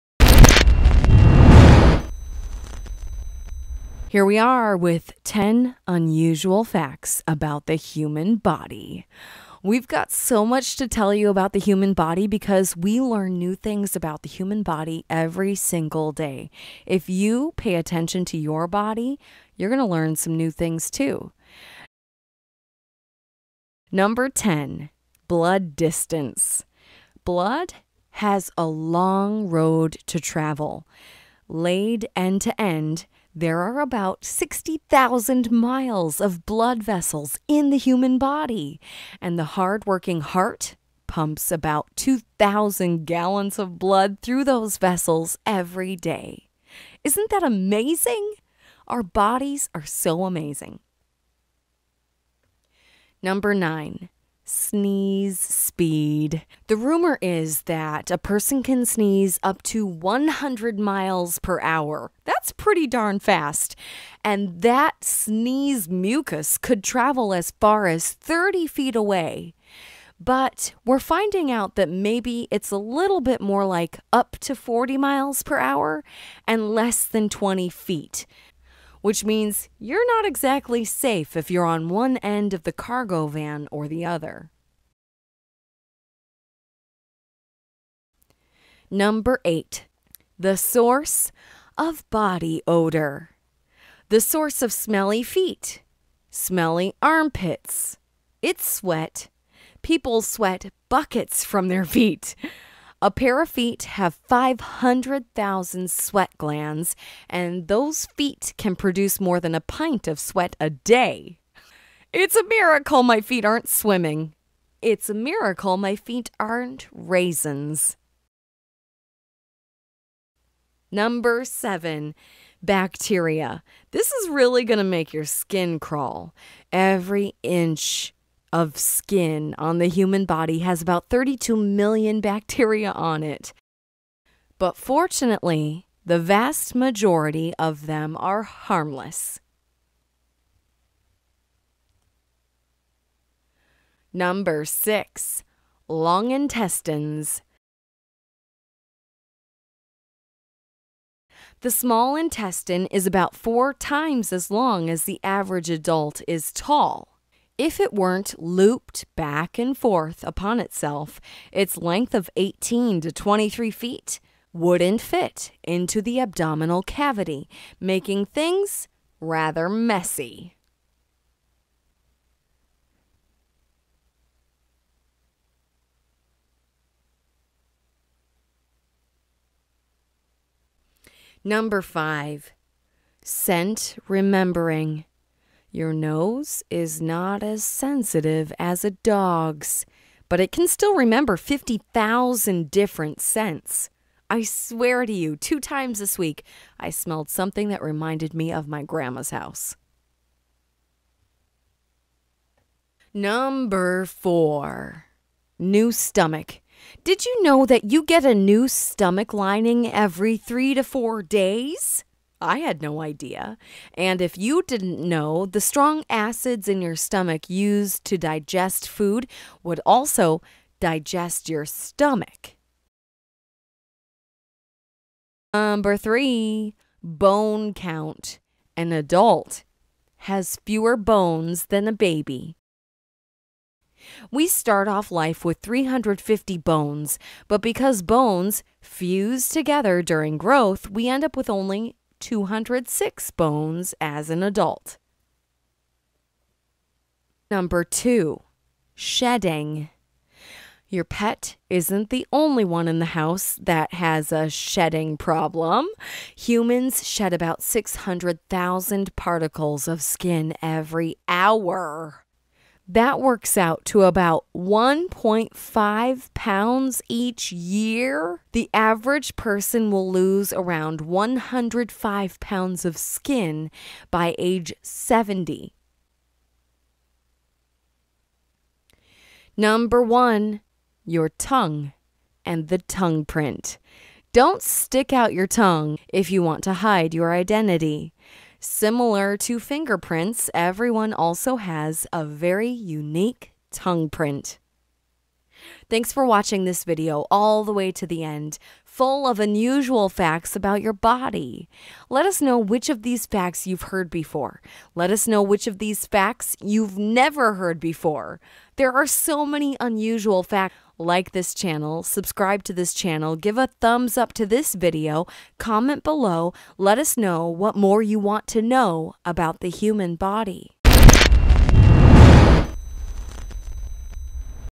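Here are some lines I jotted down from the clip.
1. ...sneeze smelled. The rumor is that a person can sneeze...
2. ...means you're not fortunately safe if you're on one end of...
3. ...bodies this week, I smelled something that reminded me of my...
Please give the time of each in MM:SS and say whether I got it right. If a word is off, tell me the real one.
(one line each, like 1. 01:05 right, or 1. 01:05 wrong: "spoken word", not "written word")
1. 00:54 wrong: "speed", not "smelled"
2. 01:19 wrong: "exactly", not "fortunately"
3. 03:15 wrong: "times", not "bodies".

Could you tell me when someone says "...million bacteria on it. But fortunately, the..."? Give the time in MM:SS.
02:11.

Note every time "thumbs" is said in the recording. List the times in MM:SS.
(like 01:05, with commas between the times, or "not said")
05:13.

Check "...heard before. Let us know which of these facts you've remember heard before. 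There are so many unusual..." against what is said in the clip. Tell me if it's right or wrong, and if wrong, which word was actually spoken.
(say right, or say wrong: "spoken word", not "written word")
wrong: "never", not "remember".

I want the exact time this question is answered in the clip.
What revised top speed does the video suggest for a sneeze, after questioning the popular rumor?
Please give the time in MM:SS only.
01:14.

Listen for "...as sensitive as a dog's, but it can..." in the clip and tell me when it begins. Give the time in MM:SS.
03:07.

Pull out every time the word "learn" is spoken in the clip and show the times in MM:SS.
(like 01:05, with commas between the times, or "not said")
00:12, 00:19.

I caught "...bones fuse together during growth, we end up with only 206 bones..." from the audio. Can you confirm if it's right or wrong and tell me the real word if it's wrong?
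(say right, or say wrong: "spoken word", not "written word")
right.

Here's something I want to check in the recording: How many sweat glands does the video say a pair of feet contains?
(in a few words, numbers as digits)
500,000.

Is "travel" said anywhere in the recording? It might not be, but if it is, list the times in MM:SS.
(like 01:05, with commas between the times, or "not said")
00:30, 01:06.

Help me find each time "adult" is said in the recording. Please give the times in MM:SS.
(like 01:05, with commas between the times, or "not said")
02:35, 03:48, 04:04.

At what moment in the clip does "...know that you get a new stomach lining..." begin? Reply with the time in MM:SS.
03:27.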